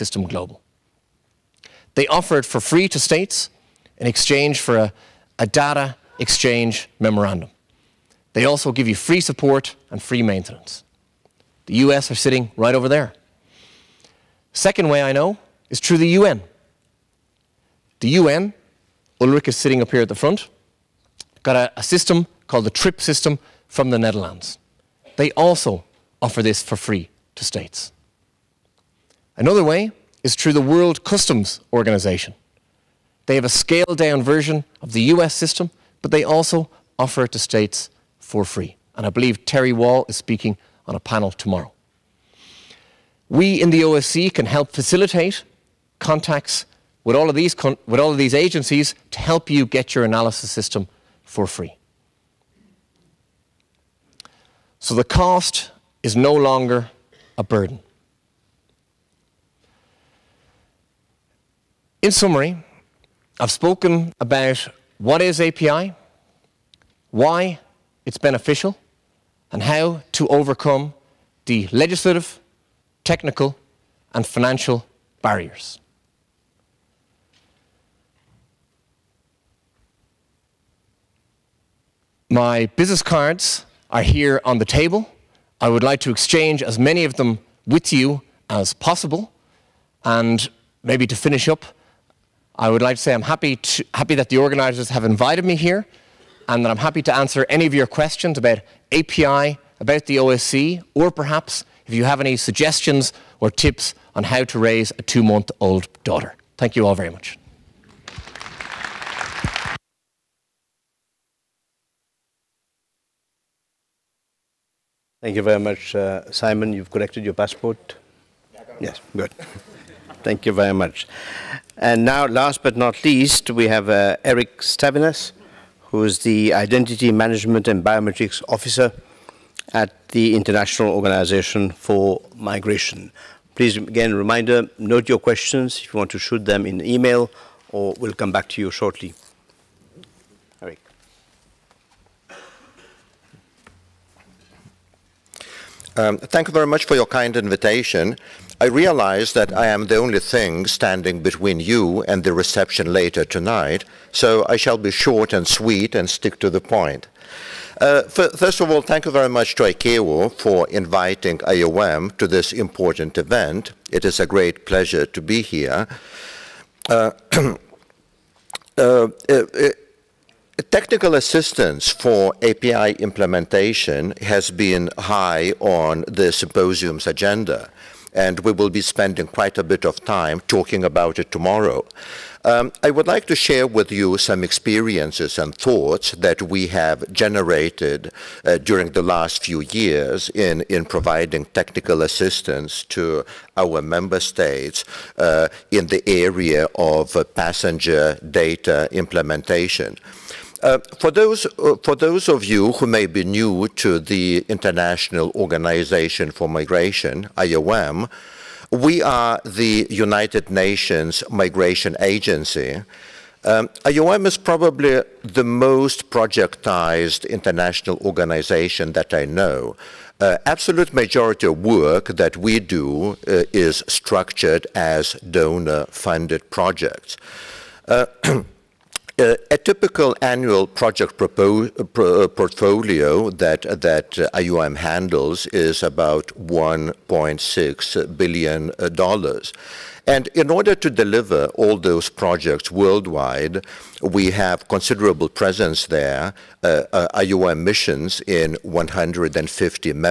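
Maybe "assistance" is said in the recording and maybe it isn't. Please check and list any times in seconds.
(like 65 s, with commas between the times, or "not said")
171 s, 192 s.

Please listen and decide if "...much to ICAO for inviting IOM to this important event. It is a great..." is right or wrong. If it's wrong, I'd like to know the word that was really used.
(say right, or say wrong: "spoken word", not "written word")
right.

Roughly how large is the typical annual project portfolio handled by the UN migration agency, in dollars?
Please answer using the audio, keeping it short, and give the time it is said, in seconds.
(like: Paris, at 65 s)
$1.6 billion, at 236 s.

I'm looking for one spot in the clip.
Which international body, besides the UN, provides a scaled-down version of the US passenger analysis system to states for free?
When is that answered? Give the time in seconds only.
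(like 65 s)
30 s.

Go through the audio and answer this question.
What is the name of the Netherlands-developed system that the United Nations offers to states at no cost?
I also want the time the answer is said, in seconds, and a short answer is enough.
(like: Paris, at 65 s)
TRIP, at 22 s.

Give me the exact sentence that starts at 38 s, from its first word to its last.
And I believe Terry Wall is speaking on a panel tomorrow.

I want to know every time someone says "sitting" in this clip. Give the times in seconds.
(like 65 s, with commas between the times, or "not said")
12 s, 19 s.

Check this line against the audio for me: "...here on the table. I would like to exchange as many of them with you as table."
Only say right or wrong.
wrong.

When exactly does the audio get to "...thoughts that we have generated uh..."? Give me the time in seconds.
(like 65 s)
185 s.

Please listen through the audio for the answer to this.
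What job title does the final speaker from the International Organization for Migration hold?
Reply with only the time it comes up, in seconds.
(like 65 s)
126 s.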